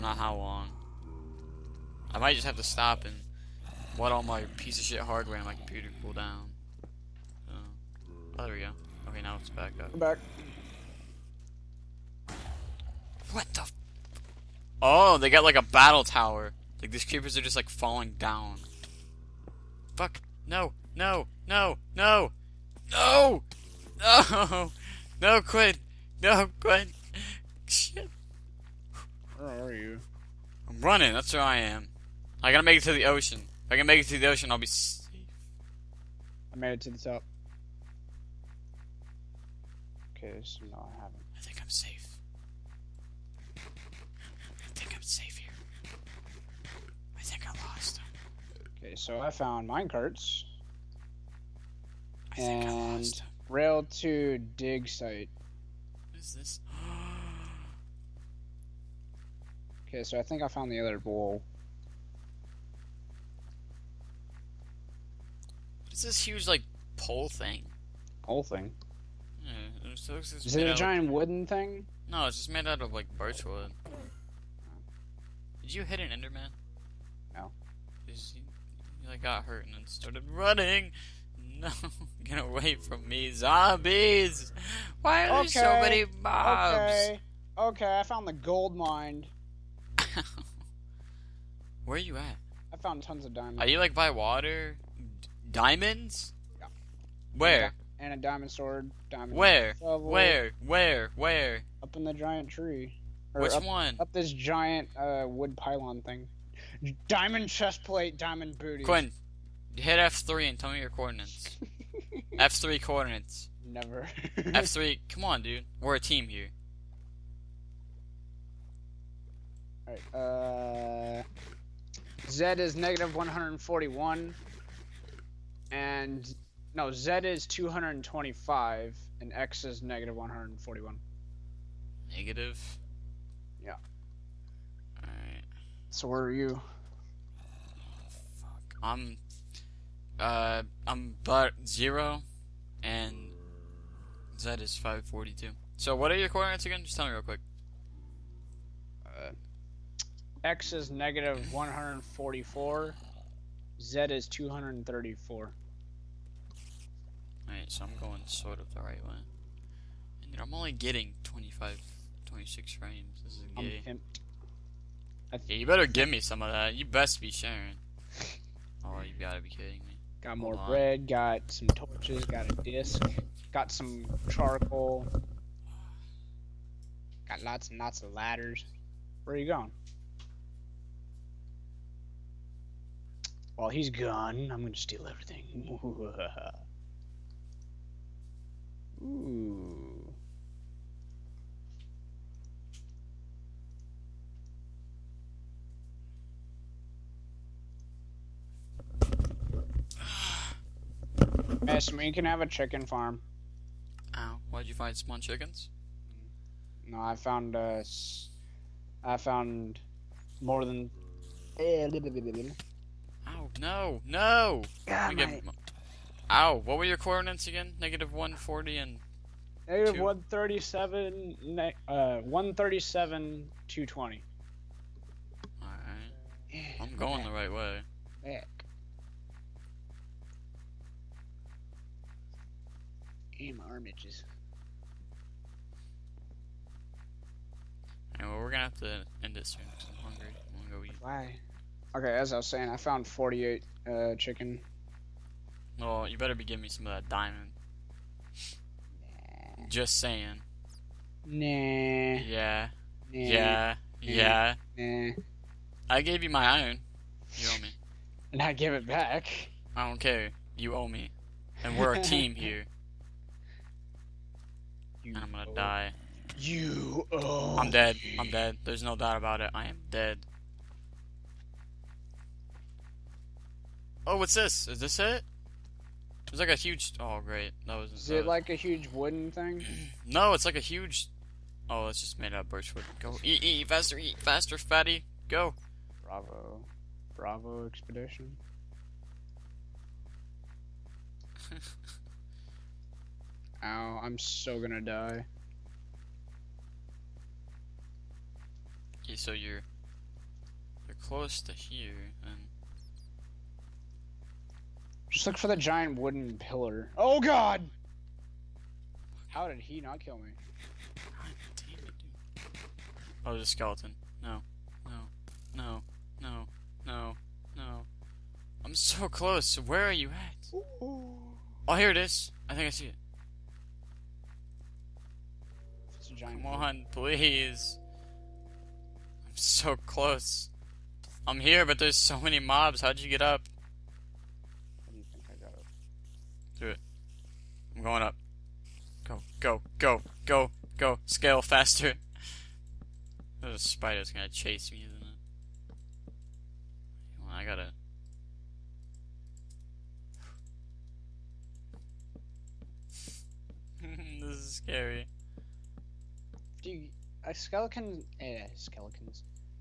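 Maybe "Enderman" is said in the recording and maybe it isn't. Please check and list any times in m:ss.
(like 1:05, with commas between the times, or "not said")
1:16.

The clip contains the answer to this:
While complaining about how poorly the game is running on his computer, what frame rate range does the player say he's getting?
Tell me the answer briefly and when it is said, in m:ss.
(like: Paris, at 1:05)
25, 26, at 2:41.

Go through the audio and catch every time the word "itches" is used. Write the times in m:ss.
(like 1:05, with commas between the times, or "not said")
3:53.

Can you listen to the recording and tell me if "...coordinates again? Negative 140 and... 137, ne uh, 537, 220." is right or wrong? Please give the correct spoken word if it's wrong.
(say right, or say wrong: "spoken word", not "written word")
wrong: "137", not "537".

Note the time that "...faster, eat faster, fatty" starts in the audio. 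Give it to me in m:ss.
4:43.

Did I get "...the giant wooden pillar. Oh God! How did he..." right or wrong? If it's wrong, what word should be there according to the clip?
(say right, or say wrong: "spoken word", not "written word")
right.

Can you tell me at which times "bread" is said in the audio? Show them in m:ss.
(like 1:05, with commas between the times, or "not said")
2:50.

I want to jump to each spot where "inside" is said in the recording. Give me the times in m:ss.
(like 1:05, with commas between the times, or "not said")
not said.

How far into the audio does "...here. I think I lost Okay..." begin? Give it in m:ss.
0:45.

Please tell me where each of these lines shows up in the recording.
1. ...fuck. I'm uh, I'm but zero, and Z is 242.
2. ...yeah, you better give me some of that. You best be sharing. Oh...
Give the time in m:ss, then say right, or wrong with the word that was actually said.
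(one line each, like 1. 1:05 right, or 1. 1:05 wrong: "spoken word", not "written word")
1. 2:18 wrong: "542", not "242"
2. 2:45 right.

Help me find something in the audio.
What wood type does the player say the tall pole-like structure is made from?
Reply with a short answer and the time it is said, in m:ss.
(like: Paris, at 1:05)
birch wood, at 1:12.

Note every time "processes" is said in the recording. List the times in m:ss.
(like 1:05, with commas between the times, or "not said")
not said.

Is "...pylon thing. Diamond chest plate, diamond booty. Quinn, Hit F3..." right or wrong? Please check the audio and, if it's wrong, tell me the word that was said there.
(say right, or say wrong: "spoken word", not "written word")
right.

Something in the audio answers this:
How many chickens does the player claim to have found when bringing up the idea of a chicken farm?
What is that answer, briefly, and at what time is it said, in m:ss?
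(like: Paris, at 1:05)
48, at 4:03.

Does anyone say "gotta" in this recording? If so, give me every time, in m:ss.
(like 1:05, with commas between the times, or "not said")
0:32, 2:49, 5:47.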